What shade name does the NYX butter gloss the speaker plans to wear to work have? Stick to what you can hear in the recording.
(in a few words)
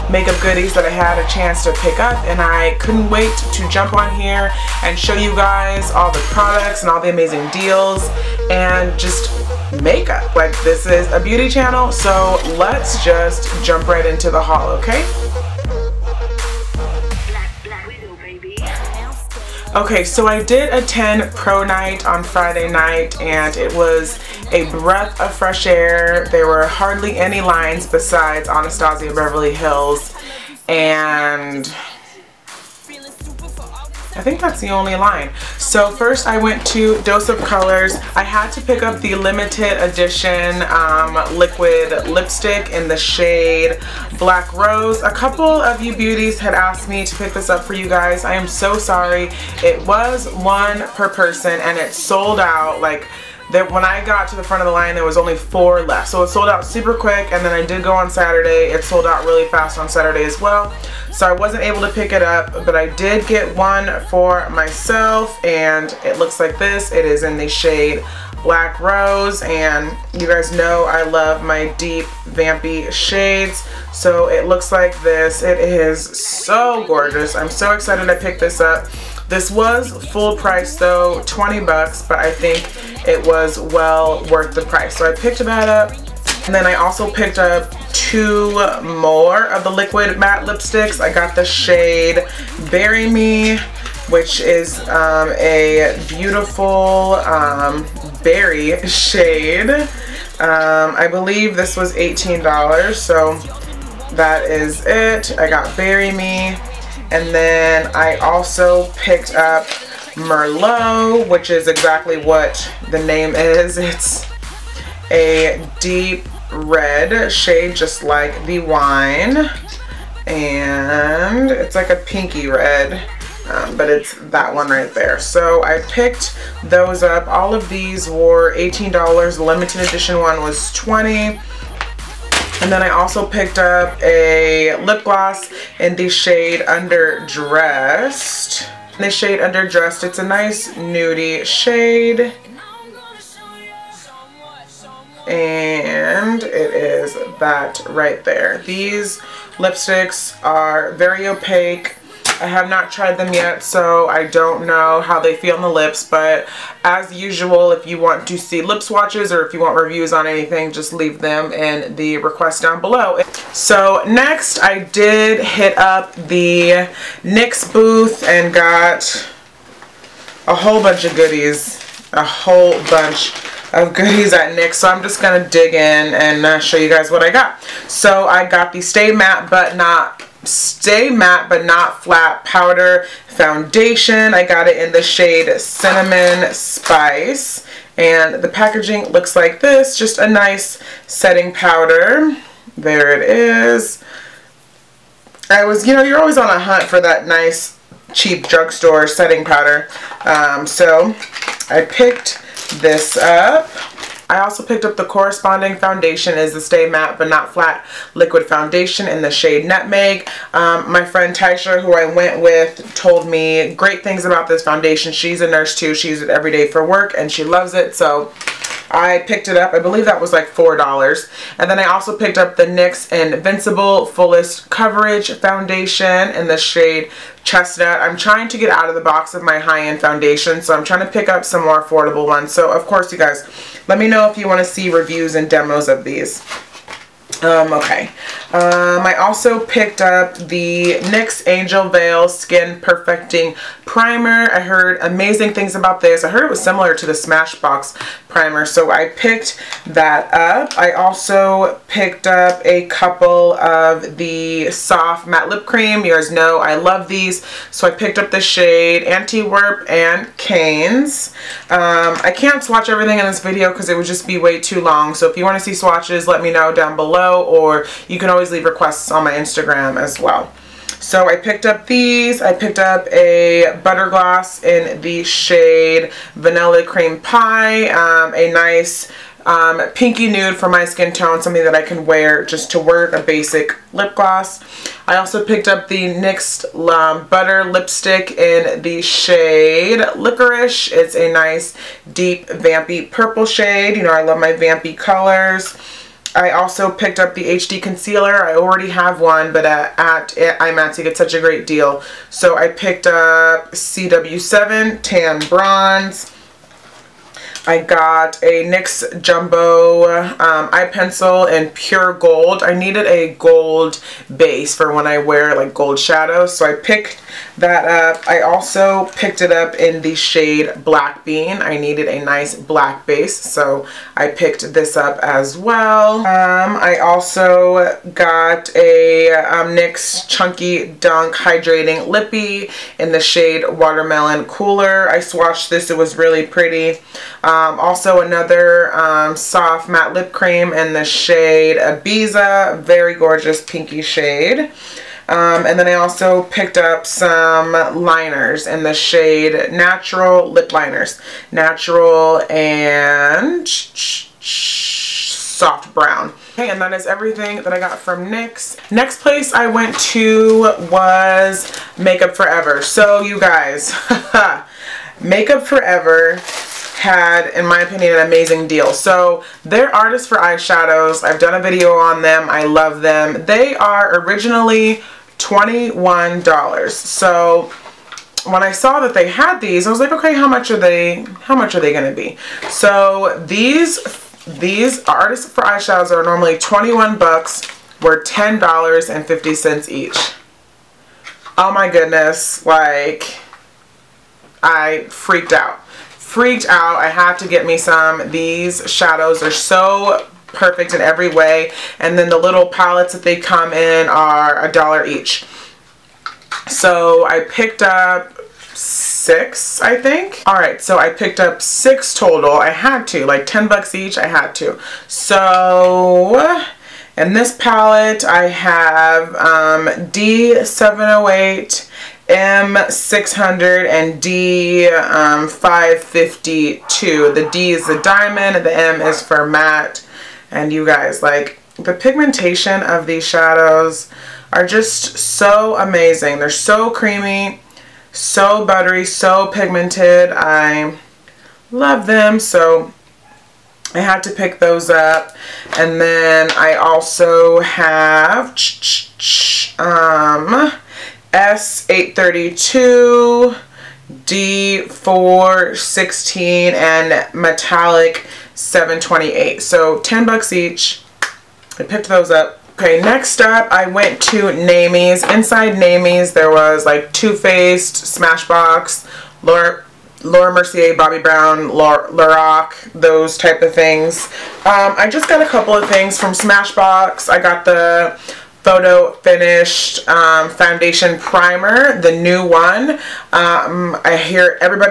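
Vanilla Cream Pie.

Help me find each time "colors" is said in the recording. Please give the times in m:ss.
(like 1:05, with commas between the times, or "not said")
0:37, 4:54.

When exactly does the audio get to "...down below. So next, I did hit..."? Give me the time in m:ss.
2:42.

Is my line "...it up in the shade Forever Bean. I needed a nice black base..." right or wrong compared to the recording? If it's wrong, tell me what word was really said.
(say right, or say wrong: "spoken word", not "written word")
wrong: "Black", not "Forever".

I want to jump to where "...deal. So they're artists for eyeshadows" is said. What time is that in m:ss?
6:08.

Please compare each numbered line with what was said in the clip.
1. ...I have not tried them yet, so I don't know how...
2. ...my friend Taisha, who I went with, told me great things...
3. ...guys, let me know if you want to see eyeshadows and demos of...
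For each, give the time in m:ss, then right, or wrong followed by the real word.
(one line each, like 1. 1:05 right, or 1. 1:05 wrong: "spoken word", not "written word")
1. 2:32 right
2. 3:30 right
3. 3:53 wrong: "reviews", not "eyeshadows".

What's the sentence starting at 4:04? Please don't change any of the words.
I heard amazing things about this.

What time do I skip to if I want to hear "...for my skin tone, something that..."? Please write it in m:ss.
4:40.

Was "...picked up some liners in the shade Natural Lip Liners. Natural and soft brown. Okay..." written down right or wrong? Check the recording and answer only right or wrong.
right.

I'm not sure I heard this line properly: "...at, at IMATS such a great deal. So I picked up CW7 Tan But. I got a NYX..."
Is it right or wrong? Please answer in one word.
wrong.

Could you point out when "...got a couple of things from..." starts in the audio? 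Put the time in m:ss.
7:55.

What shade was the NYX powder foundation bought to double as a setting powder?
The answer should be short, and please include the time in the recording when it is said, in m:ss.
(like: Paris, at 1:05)
Cinnamon Spice, at 3:05.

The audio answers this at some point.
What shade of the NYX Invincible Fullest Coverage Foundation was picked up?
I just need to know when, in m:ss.
3:47.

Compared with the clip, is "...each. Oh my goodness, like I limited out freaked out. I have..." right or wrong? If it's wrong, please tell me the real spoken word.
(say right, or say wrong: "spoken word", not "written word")
wrong: "freaked", not "limited".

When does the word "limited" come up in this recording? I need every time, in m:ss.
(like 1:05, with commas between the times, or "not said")
0:39, 2:09.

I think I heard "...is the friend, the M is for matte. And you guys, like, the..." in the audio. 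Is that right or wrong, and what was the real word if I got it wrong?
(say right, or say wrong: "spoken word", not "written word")
wrong: "diamond", not "friend".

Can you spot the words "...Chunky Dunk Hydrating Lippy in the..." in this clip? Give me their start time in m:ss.
5:30.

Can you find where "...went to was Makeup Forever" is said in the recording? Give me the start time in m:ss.
5:59.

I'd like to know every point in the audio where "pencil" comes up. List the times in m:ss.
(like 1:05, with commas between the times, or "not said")
5:10.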